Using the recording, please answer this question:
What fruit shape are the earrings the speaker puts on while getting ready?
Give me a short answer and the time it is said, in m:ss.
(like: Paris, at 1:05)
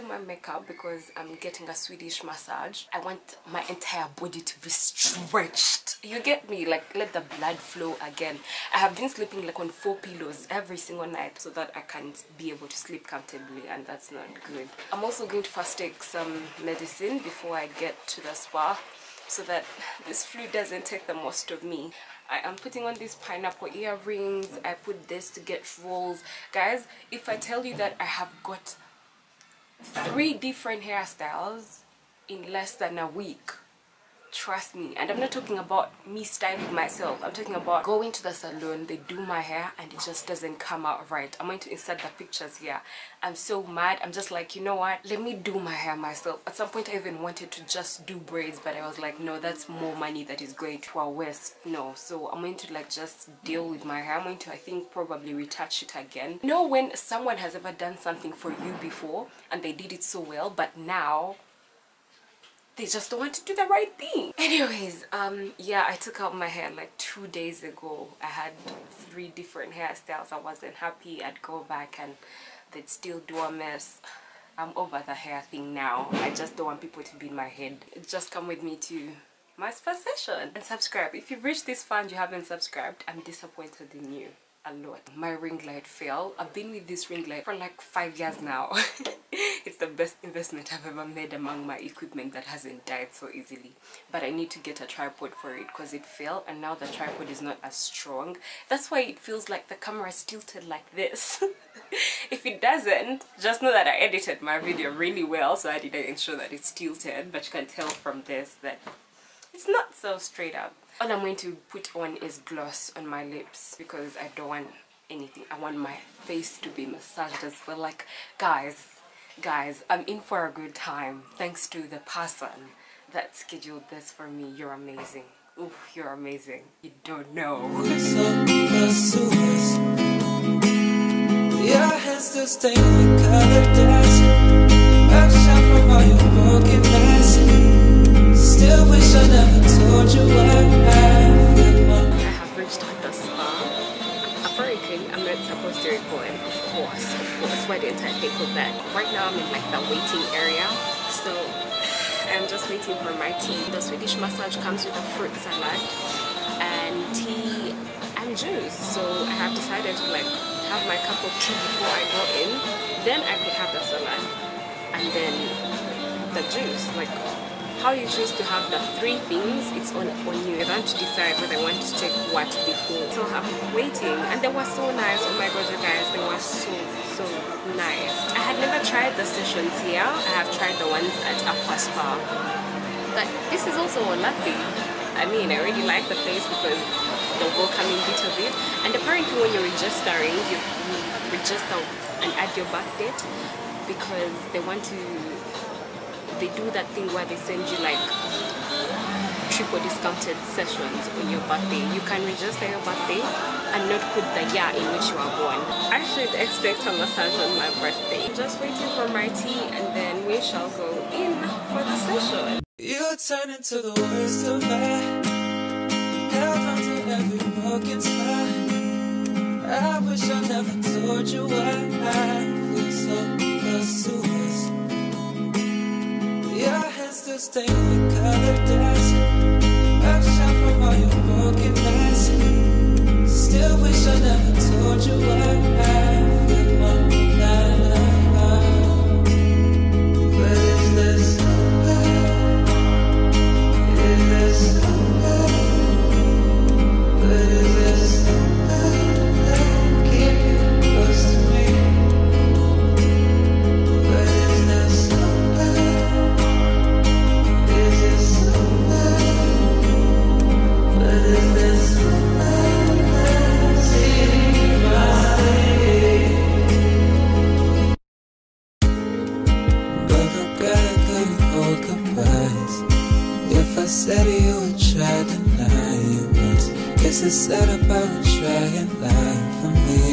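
Pineapple, at 0:23.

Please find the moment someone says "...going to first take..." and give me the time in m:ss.
0:15.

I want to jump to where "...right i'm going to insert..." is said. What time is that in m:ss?
0:41.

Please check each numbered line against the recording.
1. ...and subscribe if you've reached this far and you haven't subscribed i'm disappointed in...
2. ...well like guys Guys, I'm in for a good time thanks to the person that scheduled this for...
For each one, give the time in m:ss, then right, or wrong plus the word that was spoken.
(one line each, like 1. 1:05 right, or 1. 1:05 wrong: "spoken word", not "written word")
1. 1:20 right
2. 1:57 right.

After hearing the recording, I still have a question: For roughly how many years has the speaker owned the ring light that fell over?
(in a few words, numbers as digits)
5.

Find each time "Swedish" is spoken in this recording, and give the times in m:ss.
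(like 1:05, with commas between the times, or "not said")
0:01, 2:33.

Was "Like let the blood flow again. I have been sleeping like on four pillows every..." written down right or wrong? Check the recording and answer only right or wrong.
right.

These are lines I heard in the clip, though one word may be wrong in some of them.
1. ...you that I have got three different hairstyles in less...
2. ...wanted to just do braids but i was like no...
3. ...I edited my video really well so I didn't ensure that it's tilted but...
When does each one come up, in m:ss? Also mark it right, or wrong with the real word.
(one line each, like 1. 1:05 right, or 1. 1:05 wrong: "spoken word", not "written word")
1. 0:27 right
2. 0:47 right
3. 1:43 right.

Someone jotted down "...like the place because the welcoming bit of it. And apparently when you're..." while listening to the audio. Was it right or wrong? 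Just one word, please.
right.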